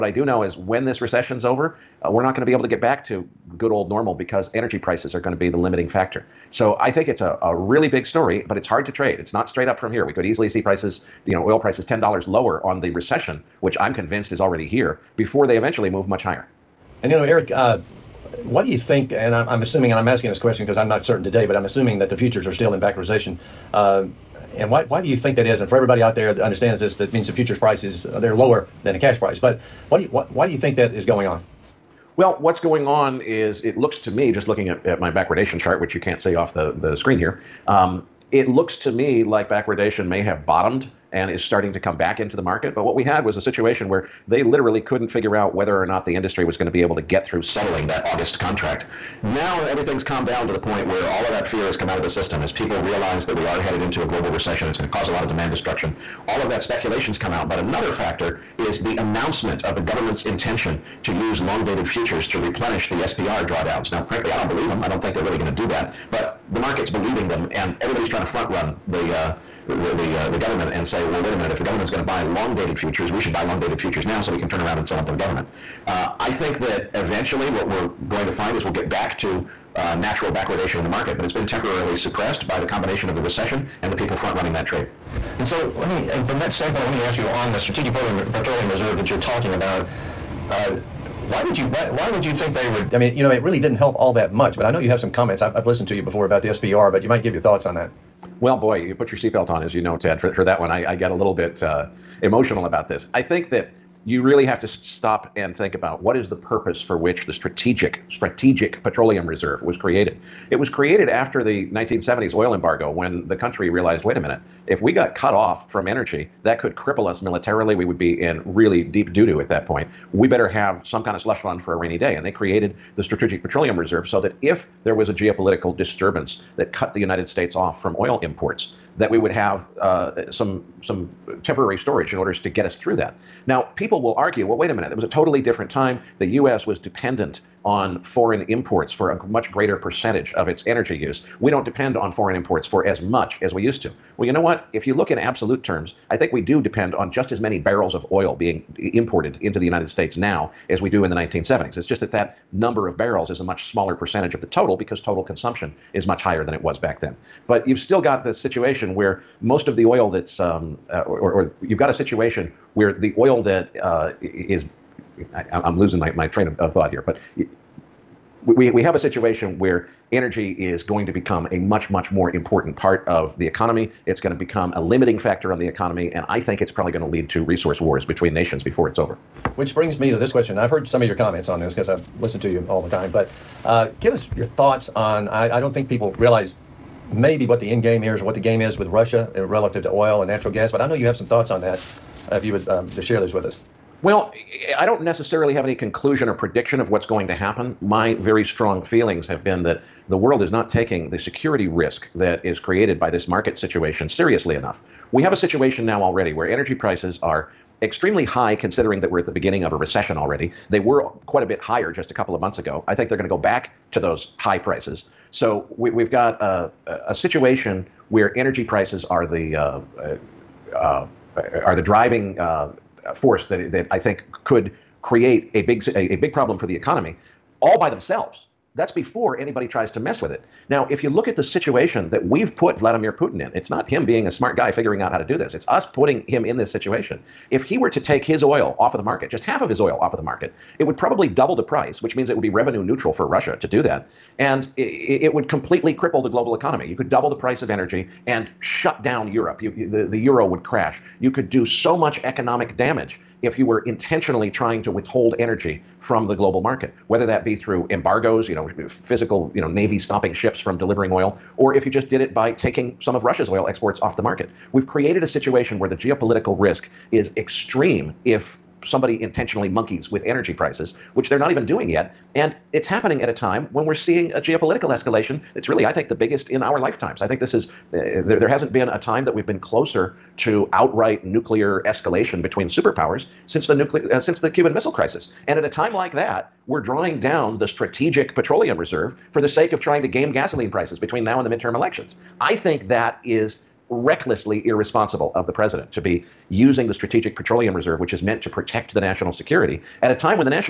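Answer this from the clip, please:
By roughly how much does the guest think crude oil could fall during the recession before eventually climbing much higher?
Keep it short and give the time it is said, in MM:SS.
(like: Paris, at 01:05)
$10, at 00:11.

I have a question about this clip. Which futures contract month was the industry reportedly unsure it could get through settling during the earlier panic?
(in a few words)
August.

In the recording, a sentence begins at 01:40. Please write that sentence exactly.
For, for that one, I, I, get a little bit uh, emotional about this.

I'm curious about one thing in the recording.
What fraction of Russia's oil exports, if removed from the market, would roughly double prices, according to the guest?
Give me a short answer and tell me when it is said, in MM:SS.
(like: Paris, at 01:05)
half, at 03:59.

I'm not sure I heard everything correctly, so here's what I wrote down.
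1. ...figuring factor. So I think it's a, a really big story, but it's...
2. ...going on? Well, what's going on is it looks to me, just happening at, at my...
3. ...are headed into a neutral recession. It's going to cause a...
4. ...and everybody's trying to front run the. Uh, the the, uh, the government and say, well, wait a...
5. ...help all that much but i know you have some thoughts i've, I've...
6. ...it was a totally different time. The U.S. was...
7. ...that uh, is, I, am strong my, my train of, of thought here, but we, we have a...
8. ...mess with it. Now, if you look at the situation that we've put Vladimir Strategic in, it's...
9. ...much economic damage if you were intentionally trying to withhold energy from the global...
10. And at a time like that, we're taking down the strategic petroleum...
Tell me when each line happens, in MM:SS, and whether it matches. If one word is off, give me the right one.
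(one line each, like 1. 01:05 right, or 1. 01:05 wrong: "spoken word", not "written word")
1. 00:05 wrong: "limiting", not "figuring"
2. 00:31 wrong: "looking", not "happening"
3. 00:53 wrong: "global", not "neutral"
4. 01:07 right
5. 01:33 wrong: "comments", not "thoughts"
6. 02:14 right
7. 02:43 wrong: "losing", not "strong"
8. 03:49 wrong: "Putin", not "Strategic"
9. 04:11 right
10. 04:45 wrong: "drawing", not "taking".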